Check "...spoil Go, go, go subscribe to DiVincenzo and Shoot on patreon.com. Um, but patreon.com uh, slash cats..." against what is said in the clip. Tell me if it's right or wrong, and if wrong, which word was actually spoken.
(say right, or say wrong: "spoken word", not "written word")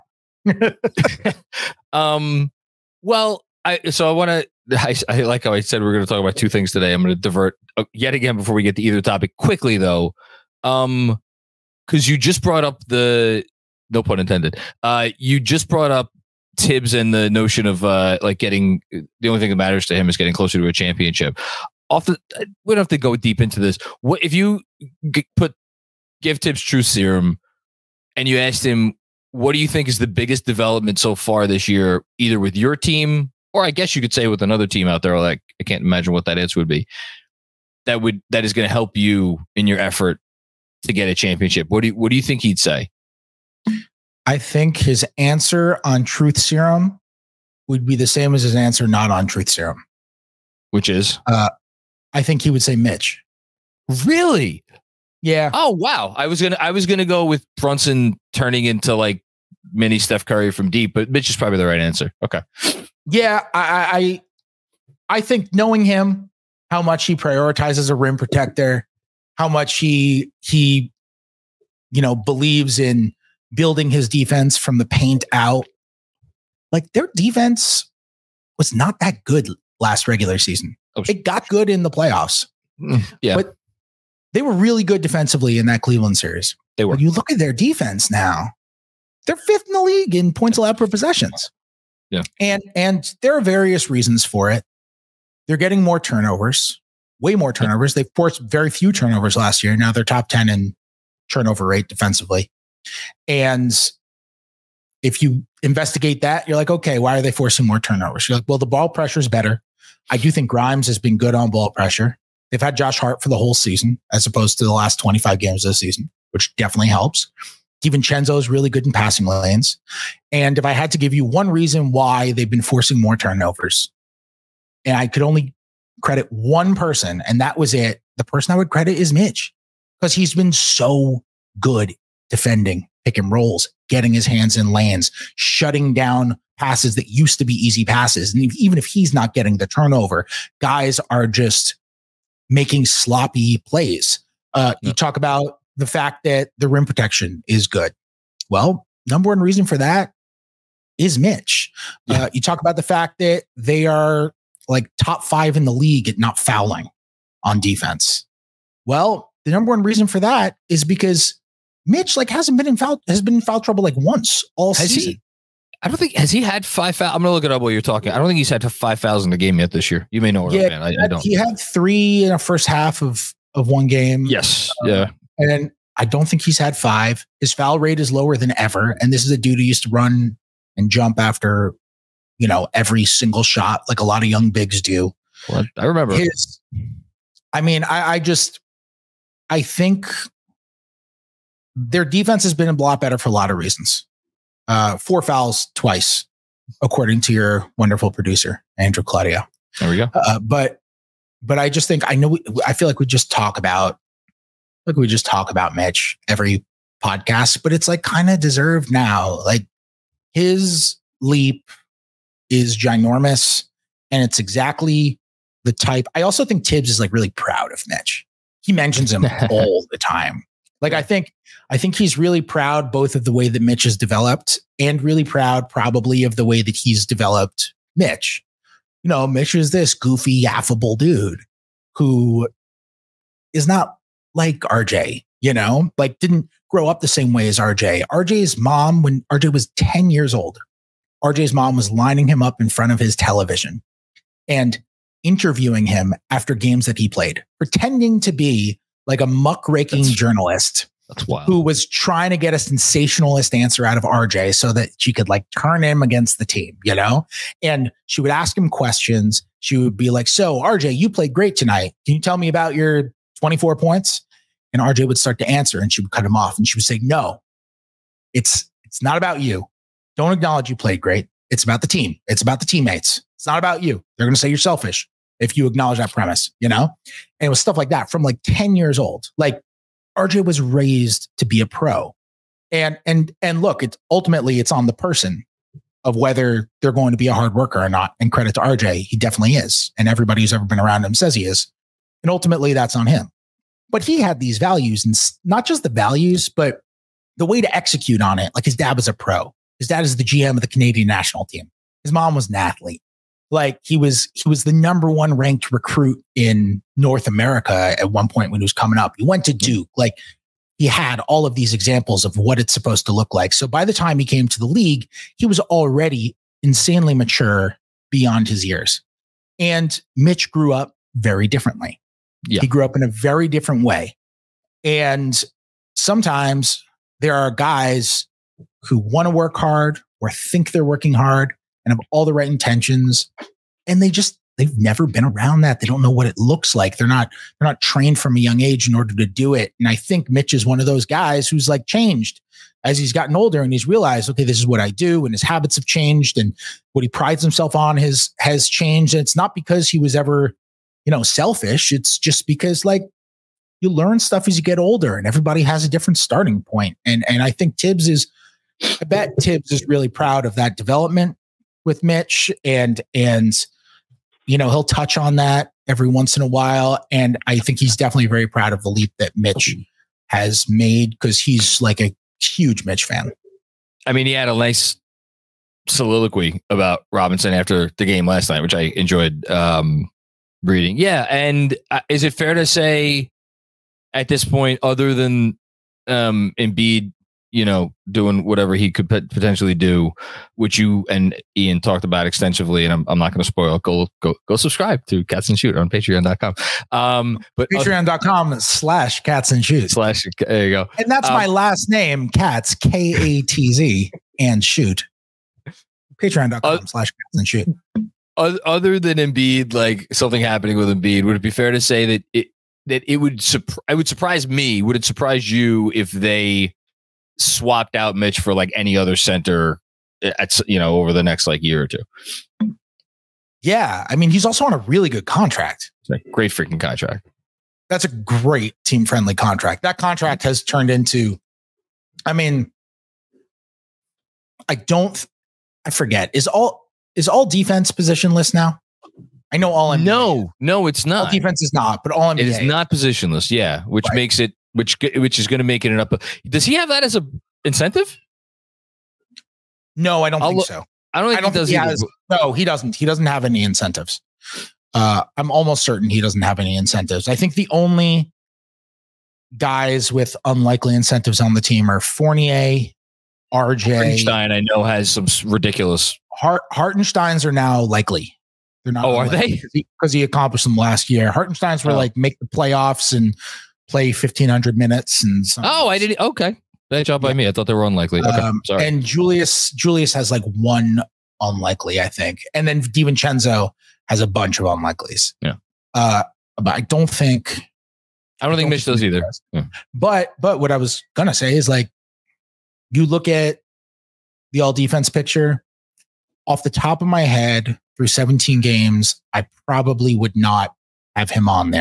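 wrong: "Cats", not "DiVincenzo".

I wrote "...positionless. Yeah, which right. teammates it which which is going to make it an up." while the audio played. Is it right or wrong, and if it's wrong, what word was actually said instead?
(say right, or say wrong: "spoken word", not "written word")
wrong: "makes", not "teammates".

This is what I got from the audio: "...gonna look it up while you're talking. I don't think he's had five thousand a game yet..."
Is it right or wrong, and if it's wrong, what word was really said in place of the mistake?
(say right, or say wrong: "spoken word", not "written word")
right.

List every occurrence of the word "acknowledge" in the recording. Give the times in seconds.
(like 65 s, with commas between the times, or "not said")
270 s, 275 s.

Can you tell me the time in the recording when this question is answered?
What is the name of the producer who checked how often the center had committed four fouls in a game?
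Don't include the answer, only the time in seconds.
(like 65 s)
198 s.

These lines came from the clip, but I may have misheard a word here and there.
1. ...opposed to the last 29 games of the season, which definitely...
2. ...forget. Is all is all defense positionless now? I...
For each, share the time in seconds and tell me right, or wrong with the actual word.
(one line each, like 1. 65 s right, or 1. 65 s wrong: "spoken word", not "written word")
1. 114 s wrong: "25", not "29"
2. 435 s right.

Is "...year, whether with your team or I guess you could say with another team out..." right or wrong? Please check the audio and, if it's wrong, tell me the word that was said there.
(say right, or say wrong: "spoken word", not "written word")
wrong: "either", not "whether".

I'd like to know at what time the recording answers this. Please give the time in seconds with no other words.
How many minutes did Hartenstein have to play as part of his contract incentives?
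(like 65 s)
474 s.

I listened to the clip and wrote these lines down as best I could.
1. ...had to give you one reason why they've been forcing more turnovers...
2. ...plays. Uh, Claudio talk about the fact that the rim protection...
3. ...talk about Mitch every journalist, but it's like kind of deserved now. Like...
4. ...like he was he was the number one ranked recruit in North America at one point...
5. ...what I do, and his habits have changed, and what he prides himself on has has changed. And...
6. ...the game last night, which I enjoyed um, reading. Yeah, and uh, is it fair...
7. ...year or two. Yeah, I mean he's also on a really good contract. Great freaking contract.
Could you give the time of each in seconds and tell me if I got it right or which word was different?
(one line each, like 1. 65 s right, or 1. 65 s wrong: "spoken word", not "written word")
1. 120 s right
2. 143 s wrong: "You", not "Claudio"
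3. 205 s wrong: "podcast", not "journalist"
4. 303 s right
5. 344 s right
6. 377 s right
7. 421 s right.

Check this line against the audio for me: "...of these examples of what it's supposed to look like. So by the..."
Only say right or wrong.
right.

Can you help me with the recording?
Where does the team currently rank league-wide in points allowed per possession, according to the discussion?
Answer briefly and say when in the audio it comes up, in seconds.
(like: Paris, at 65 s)
Fifth, at 89 s.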